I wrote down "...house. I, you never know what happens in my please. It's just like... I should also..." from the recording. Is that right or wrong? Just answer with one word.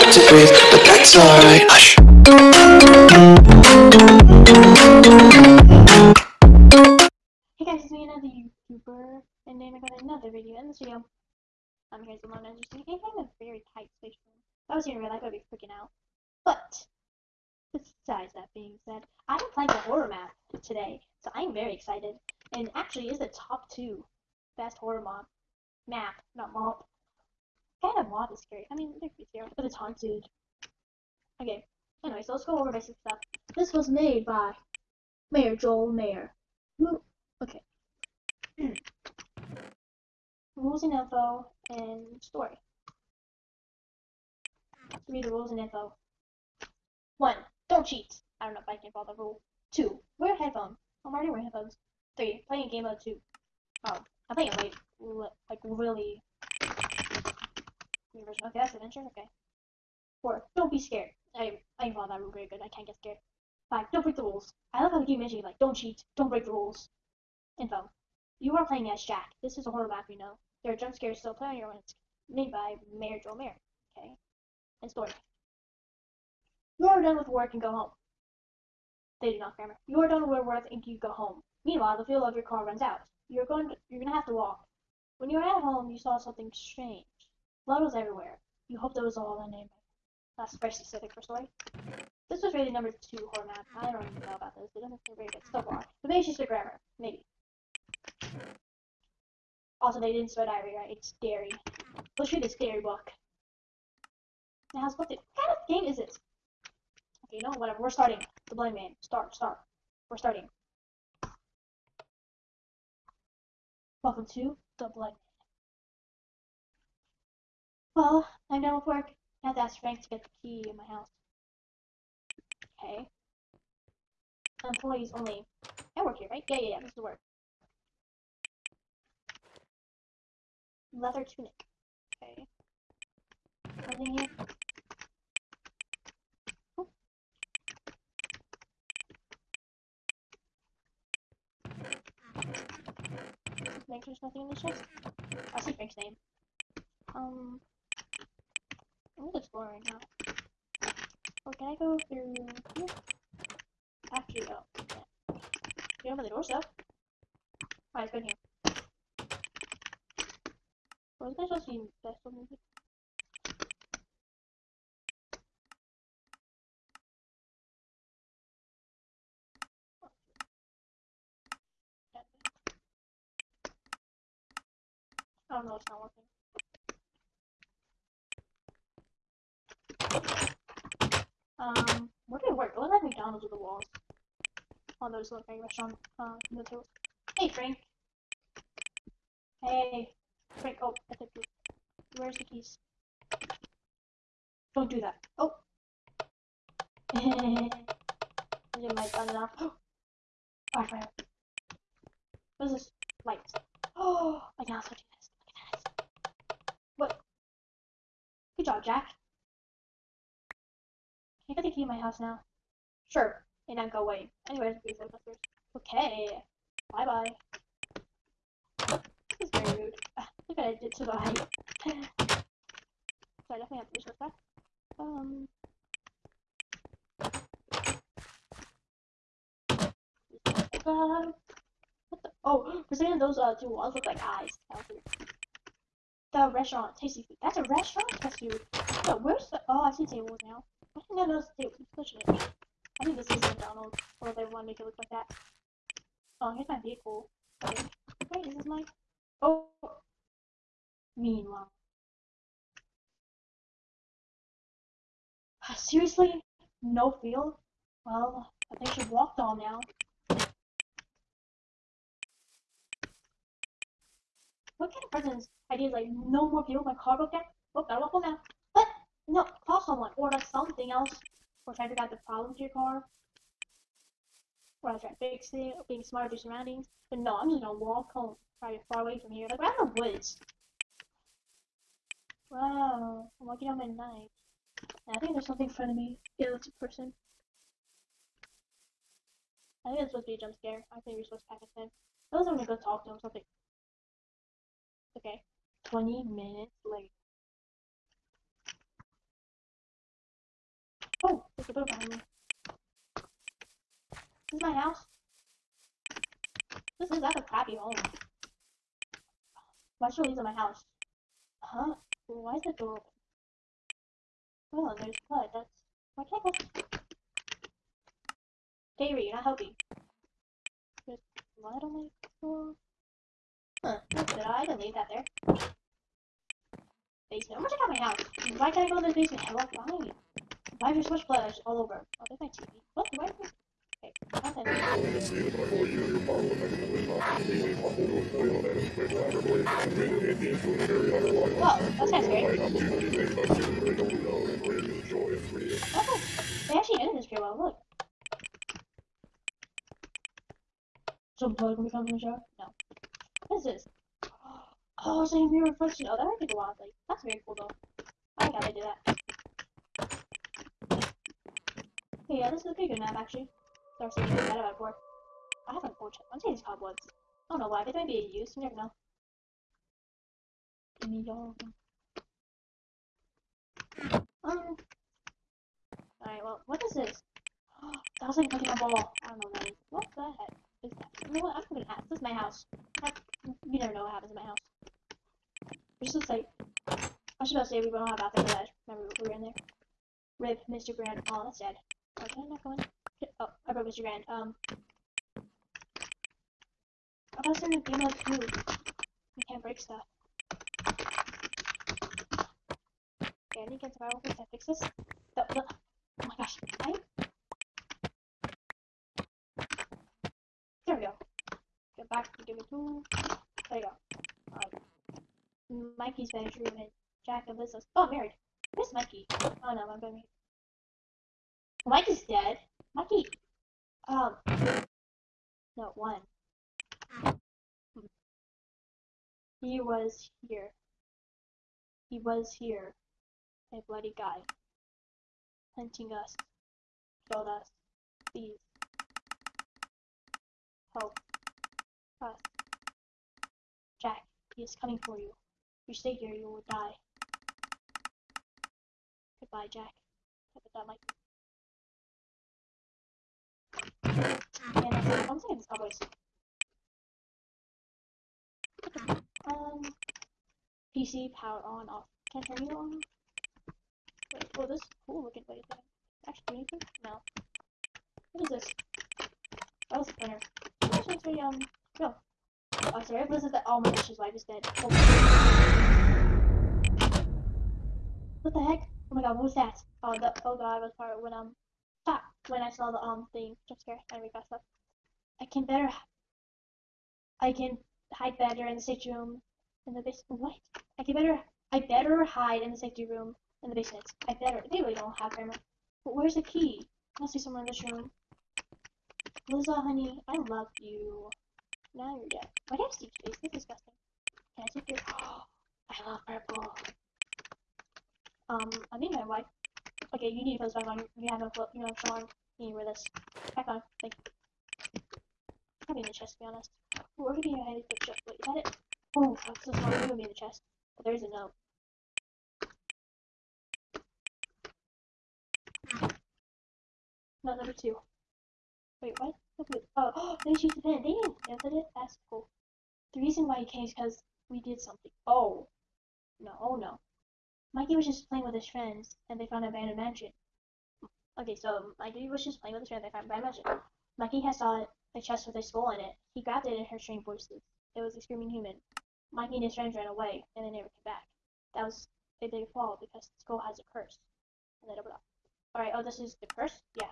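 wrong.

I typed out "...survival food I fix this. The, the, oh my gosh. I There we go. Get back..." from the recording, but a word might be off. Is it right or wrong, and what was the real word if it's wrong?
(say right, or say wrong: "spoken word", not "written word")
right.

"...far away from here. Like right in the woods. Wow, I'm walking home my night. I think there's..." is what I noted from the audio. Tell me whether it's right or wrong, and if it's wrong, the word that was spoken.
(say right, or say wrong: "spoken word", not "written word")
right.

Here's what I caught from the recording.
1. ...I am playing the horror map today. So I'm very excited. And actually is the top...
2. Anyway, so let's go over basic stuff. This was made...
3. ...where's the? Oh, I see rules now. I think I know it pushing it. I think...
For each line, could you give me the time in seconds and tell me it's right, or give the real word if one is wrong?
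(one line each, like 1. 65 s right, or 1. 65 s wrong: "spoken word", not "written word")
1. 19 s right
2. 32 s right
3. 239 s wrong: "tables", not "rules".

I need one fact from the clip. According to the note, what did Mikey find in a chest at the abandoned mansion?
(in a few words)
A skull.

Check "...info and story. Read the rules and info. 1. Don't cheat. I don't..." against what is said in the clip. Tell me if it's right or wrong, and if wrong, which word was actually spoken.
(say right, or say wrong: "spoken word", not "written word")
right.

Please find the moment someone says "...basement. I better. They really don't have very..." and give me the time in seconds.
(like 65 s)
493 s.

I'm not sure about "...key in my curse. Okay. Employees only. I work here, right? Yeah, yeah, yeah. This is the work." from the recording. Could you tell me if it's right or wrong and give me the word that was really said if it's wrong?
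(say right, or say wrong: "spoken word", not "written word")
wrong: "house", not "curse".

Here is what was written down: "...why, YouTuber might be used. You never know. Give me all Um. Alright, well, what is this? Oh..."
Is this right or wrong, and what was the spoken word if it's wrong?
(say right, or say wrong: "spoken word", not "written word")
wrong: "They", not "YouTuber".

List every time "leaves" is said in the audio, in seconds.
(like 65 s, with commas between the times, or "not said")
310 s, 324 s.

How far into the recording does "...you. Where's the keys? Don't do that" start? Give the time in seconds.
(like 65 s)
191 s.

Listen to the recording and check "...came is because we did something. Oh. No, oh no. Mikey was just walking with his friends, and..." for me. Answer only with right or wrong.
wrong.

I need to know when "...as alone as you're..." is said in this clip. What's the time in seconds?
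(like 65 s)
12 s.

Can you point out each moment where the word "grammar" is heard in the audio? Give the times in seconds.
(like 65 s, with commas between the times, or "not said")
79 s, 96 s.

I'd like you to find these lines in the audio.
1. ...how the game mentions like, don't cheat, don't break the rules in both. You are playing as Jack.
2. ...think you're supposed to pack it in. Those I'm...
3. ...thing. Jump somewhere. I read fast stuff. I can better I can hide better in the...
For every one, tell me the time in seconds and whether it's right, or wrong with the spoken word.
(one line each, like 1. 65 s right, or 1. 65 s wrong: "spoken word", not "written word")
1. 64 s right
2. 291 s right
3. 483 s wrong: "scare", not "somewhere".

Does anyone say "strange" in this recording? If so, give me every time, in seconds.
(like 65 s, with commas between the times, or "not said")
86 s, 546 s.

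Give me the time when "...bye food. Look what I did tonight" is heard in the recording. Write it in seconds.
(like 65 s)
217 s.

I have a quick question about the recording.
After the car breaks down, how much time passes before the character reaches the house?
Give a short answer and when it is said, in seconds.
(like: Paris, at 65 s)
Twenty minutes, at 295 s.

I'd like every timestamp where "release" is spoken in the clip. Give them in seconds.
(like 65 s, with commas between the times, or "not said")
not said.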